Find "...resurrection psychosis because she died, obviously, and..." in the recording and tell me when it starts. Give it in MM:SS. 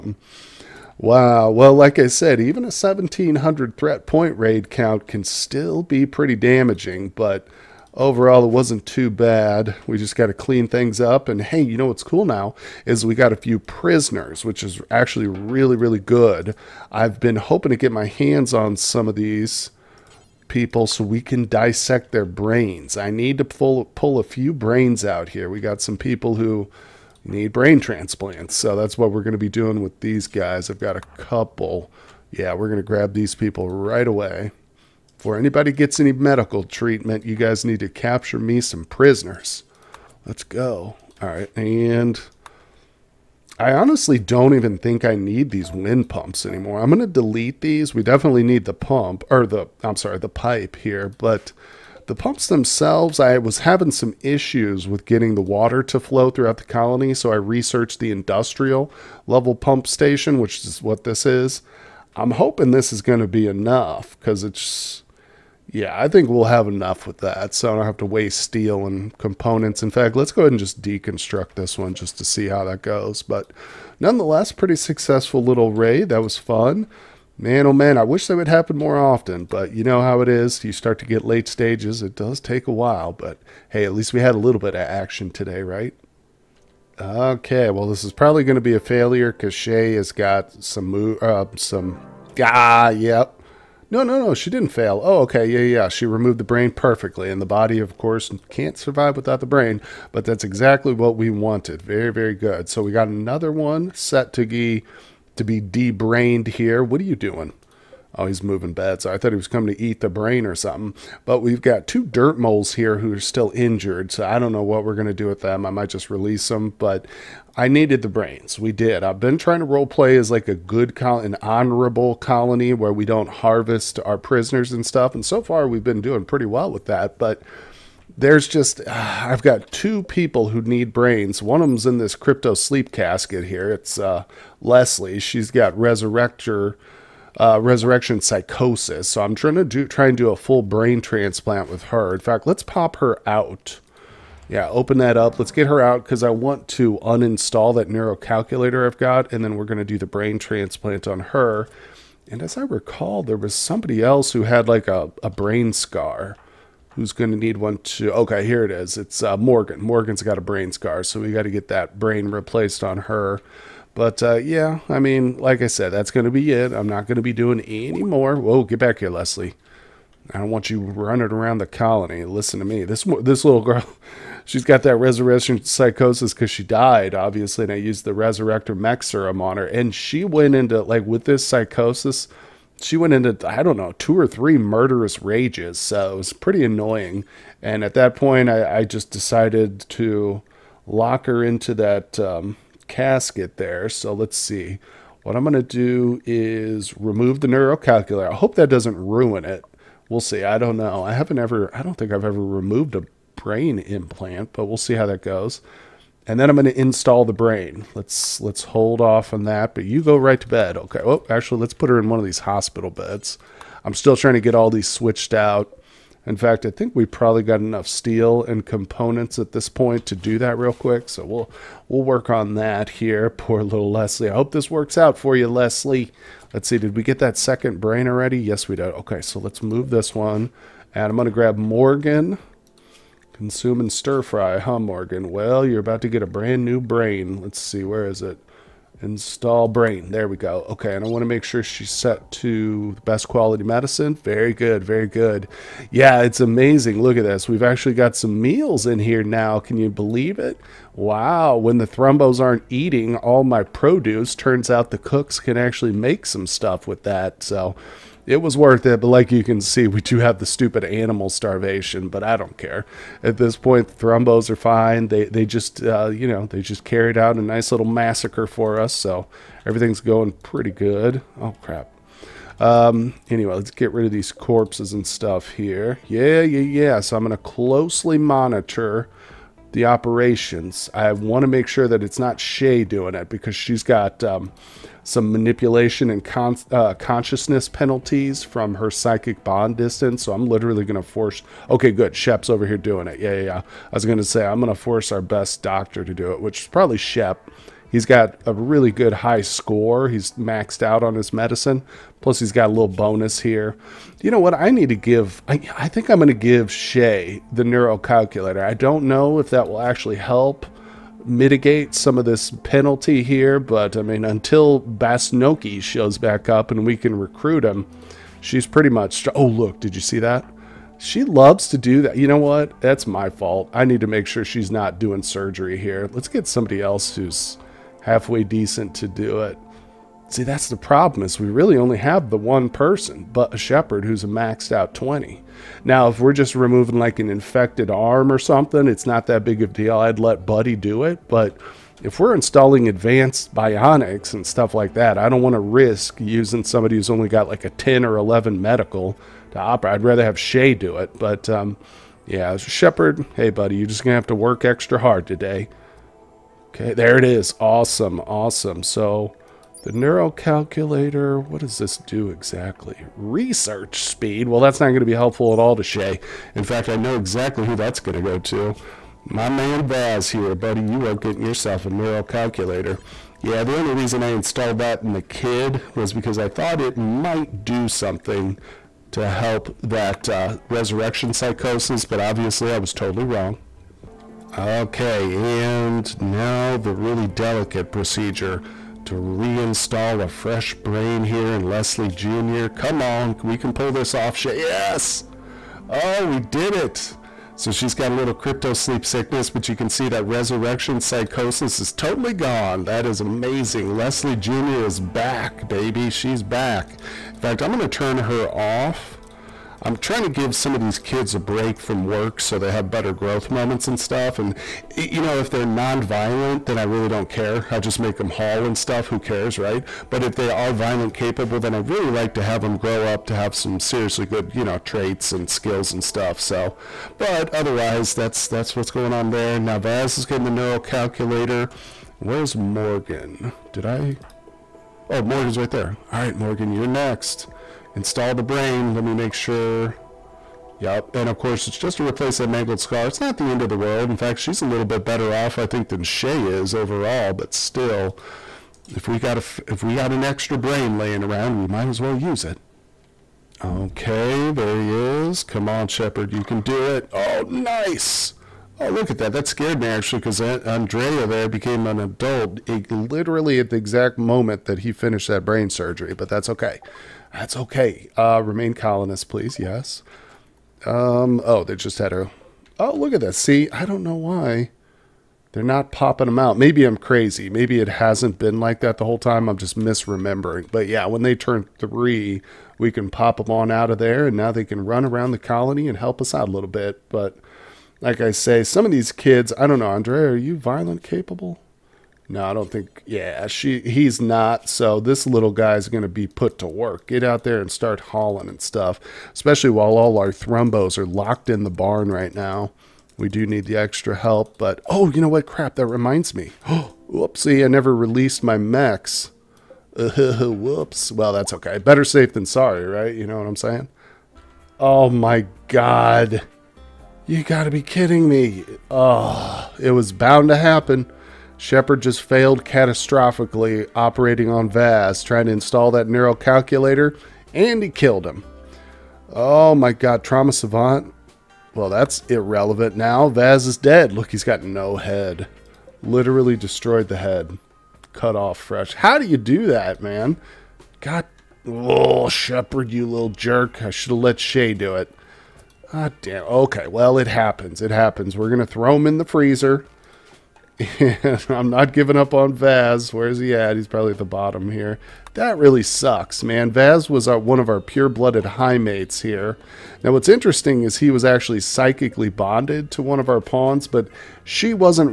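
02:54.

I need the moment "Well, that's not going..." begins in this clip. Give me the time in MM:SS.
06:04.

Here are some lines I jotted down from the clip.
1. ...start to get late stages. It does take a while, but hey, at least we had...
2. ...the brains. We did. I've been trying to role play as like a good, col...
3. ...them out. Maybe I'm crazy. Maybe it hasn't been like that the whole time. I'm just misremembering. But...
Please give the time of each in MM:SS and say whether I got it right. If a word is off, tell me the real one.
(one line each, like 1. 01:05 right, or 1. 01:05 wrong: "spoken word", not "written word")
1. 01:20 right
2. 01:58 right
3. 07:56 right.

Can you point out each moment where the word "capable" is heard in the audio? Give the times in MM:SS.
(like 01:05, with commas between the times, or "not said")
07:01, 08:11.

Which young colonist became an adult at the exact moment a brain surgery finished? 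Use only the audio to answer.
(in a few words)
Andrea.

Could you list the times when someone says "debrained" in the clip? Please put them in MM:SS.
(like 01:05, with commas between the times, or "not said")
01:45.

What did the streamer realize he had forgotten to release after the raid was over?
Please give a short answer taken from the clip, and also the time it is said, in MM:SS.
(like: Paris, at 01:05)
mechs, at 08:28.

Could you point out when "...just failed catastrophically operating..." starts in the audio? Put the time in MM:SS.
08:42.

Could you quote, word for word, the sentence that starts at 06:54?
And, you know, if they're nonviolent, then I really don't care.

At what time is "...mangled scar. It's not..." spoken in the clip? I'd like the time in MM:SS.
07:22.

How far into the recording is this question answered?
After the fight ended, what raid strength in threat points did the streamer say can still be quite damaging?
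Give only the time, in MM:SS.
00:02.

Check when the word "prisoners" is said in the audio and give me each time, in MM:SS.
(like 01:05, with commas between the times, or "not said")
00:13, 00:38, 02:04.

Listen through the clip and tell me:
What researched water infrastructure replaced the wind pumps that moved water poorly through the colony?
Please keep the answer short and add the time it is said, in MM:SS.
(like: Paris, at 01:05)
industrial level pump station, at 00:58.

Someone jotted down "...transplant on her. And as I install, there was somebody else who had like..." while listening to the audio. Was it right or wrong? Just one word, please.
wrong.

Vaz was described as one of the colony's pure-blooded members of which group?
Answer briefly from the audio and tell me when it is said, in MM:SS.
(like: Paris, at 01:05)
high mates, at 09:18.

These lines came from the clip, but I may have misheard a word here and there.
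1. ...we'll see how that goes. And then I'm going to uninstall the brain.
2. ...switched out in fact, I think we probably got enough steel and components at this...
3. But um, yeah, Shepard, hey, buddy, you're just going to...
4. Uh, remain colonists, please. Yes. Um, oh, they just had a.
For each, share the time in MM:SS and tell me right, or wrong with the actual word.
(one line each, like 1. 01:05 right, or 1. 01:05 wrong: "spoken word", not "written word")
1. 03:24 wrong: "install", not "uninstall"
2. 03:34 right
3. 05:51 right
4. 07:48 right.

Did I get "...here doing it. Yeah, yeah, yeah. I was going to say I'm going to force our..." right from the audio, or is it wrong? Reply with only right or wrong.
right.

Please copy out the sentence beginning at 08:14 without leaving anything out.
So this little guy's going to be put to work.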